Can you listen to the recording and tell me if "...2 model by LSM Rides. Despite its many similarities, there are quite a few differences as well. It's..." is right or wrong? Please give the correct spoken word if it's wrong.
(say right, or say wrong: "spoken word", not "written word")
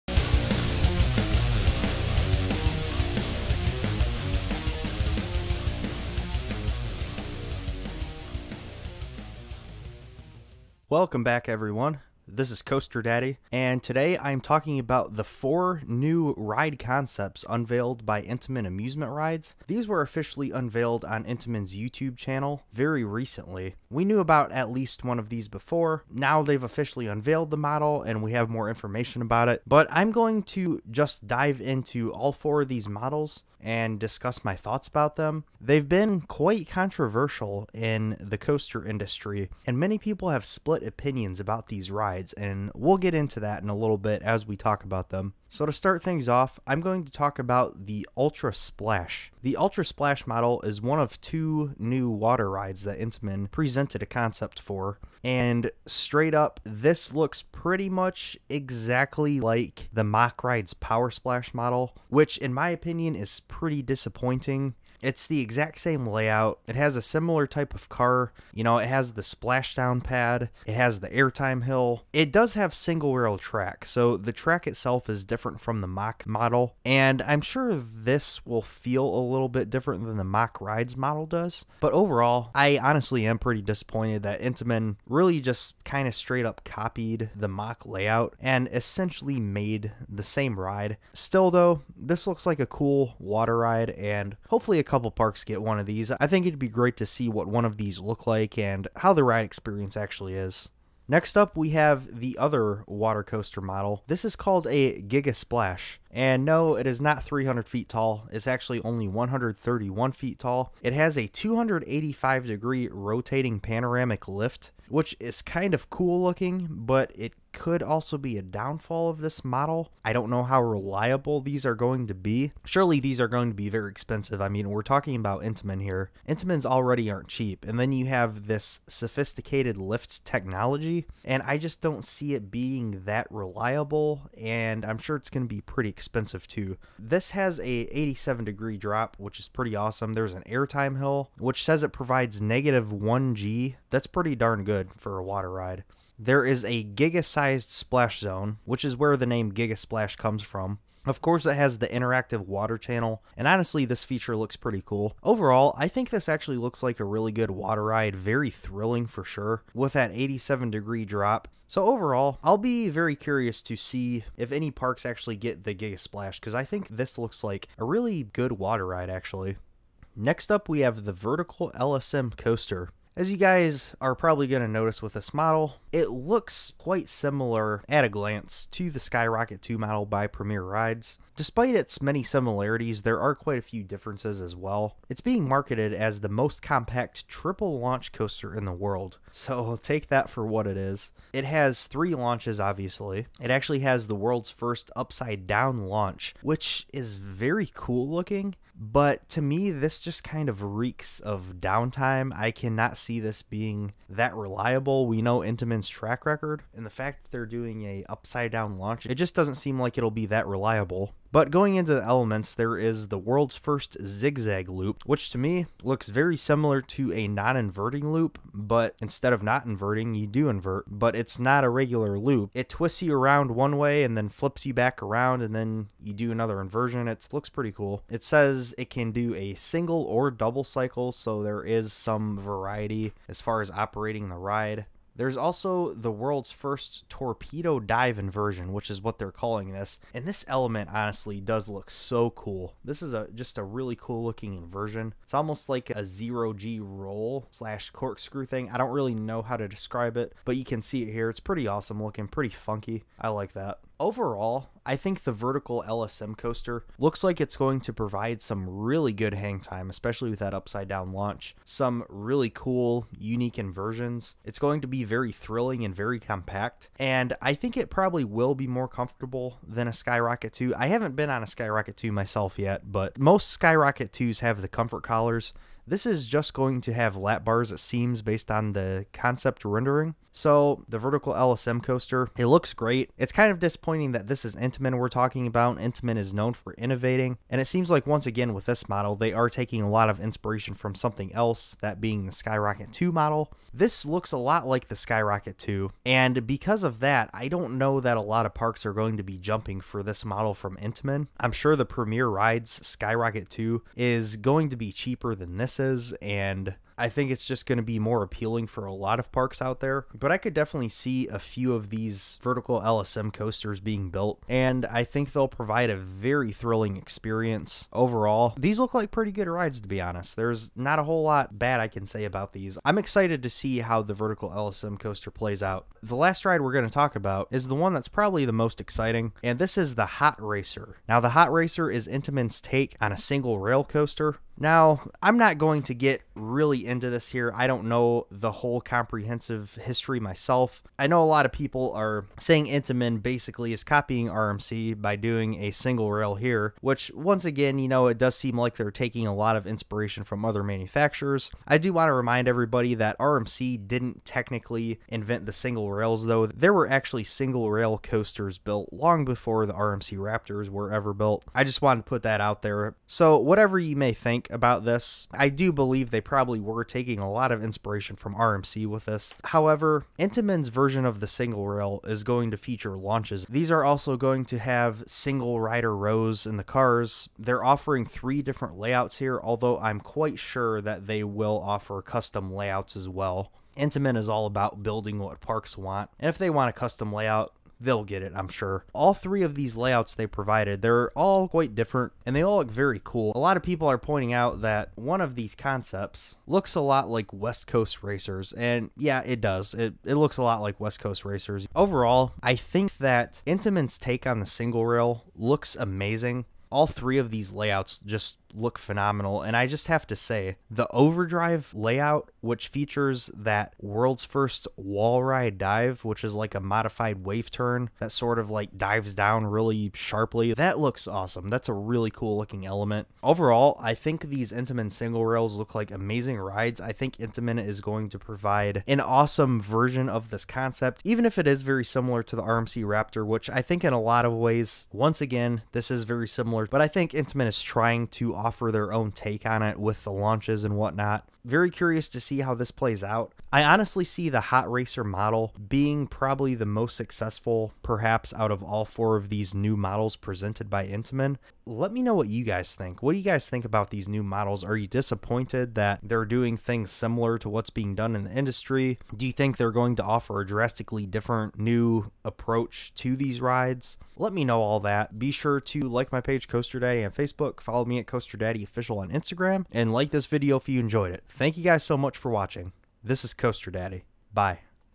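wrong: "Premier", not "LSM".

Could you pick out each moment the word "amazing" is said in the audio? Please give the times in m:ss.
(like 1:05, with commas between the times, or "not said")
6:45, 7:05.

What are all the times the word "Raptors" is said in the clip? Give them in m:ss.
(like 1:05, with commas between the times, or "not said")
6:00, 7:12.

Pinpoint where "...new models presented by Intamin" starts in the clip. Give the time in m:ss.
7:29.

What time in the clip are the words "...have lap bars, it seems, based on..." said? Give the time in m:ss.
4:36.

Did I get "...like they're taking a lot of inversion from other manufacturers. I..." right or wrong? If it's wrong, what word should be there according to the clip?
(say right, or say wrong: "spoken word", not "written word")
wrong: "inspiration", not "inversion".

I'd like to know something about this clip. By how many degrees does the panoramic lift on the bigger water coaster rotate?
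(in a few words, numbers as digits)
285 degrees.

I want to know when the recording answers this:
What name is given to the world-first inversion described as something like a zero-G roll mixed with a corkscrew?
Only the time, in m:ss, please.
3:57.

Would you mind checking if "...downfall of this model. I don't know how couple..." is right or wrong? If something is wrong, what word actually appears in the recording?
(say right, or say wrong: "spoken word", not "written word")
wrong: "reliable", not "couple".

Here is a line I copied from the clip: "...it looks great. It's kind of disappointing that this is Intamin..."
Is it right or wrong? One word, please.
right.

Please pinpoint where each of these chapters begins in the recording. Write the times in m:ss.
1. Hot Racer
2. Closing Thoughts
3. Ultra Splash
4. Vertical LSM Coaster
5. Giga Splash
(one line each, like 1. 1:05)
1. 5:25
2. 7:21
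3. 0:48
4. 2:49
5. 1:40.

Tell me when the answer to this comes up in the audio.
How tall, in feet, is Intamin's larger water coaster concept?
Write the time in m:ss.
1:49.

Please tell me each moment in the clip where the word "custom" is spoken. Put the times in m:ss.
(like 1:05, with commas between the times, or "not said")
6:22, 6:26.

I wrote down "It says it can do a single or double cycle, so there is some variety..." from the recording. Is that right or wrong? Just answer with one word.
right.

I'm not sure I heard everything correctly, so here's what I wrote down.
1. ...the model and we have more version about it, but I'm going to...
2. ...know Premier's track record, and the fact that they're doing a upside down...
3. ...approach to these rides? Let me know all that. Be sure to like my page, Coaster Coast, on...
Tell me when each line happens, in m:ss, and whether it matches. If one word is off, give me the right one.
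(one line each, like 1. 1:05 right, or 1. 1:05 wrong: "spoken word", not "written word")
1. 0:27 wrong: "information", not "version"
2. 3:25 wrong: "Intamin", not "Premier"
3. 7:42 wrong: "Daddy", not "Coast".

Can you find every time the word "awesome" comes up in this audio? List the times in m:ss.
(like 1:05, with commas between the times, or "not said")
2:19, 4:11, 7:01, 7:08.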